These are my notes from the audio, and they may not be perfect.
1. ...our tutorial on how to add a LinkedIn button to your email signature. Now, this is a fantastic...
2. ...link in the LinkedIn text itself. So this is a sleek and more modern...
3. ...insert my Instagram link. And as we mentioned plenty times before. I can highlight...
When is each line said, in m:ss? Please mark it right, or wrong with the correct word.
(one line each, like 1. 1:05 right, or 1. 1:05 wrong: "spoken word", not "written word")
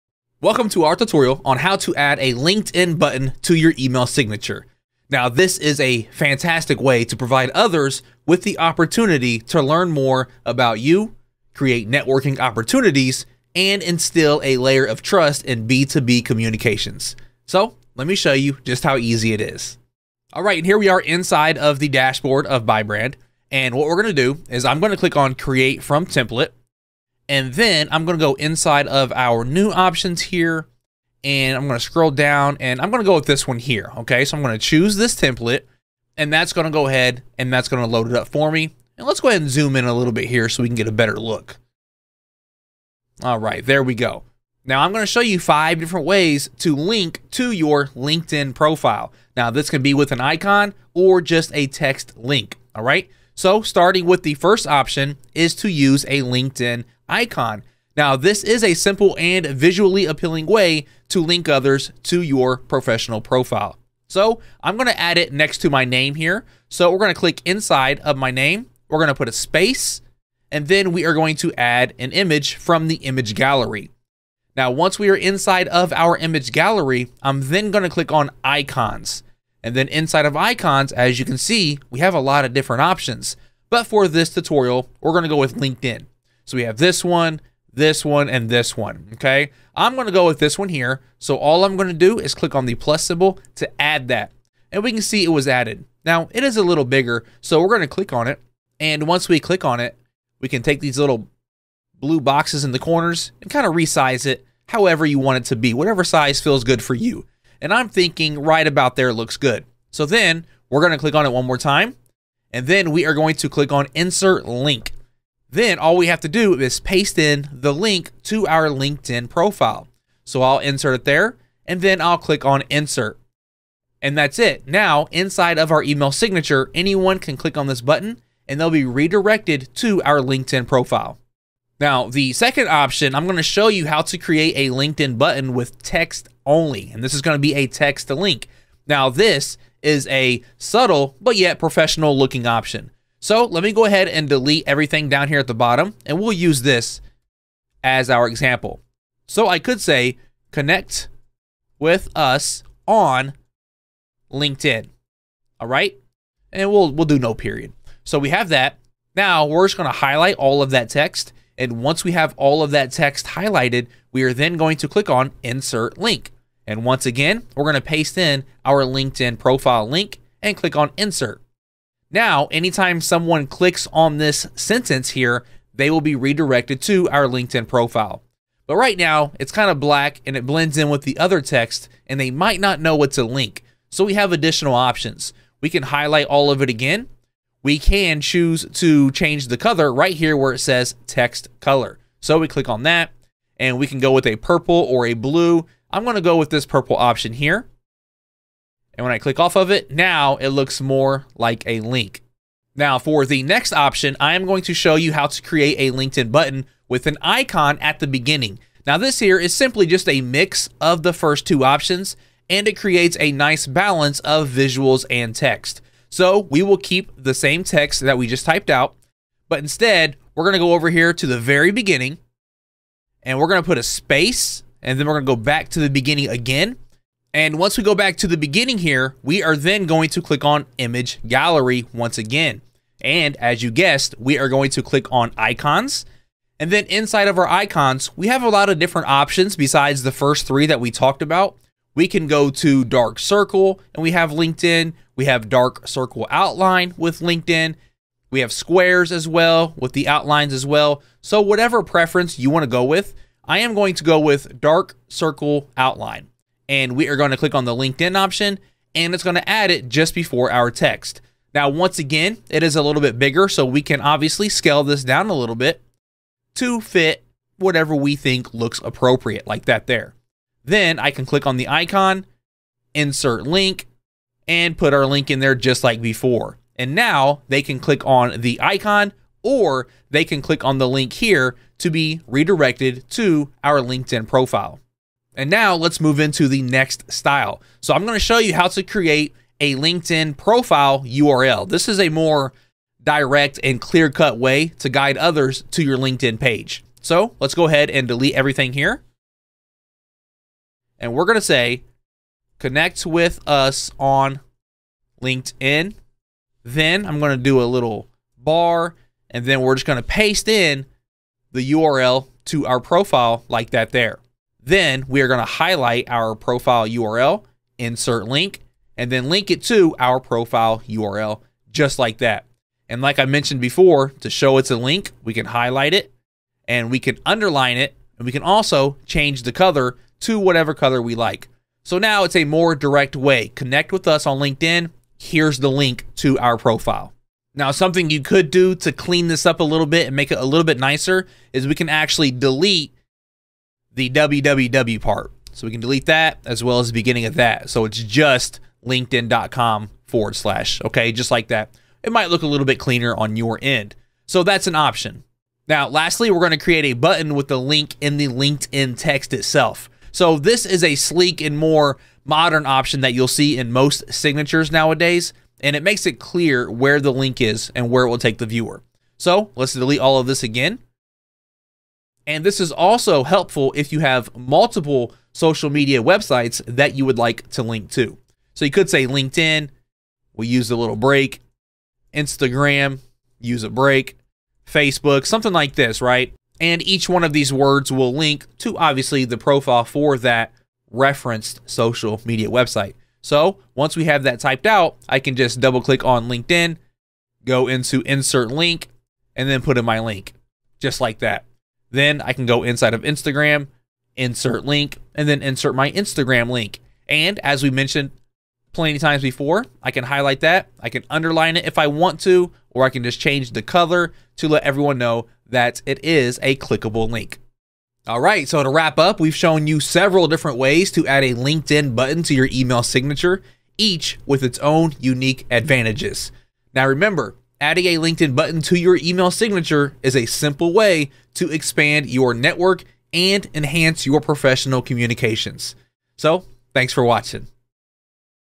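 1. 0:00 right
2. 5:57 right
3. 6:45 right.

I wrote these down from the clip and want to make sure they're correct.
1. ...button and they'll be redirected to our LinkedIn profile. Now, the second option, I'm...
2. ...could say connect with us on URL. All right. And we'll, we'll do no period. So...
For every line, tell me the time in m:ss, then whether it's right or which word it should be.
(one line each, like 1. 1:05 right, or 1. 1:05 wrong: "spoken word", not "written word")
1. 2:07 right
2. 2:29 wrong: "LinkedIn", not "URL".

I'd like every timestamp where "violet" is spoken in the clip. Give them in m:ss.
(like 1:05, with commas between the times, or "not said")
not said.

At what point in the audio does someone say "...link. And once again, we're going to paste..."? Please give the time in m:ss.
2:45.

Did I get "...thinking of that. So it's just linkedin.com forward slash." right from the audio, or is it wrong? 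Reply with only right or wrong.
wrong.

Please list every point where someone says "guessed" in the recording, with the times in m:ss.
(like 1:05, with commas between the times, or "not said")
3:53.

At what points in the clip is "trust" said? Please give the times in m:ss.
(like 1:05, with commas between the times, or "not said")
0:15.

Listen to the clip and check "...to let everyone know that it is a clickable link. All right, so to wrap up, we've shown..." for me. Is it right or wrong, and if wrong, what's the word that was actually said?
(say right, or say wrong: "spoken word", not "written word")
right.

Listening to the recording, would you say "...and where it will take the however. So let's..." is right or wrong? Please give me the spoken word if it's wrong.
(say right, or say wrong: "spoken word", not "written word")
wrong: "viewer", not "however".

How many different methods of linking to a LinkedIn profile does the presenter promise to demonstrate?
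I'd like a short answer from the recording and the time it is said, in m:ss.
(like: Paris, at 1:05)
5, at 0:45.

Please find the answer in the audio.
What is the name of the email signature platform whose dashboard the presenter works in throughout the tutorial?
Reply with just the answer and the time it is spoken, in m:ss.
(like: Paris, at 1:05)
ByBrand, at 0:22.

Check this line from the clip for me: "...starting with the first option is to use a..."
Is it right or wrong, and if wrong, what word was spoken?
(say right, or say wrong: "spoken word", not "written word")
right.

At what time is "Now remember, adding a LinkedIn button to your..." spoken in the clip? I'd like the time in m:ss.
7:06.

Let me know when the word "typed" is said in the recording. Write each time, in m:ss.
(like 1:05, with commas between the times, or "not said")
3:38, 6:34.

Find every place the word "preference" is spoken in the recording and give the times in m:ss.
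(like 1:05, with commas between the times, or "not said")
4:11.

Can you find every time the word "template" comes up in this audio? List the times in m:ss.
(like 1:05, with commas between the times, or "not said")
0:26, 0:35.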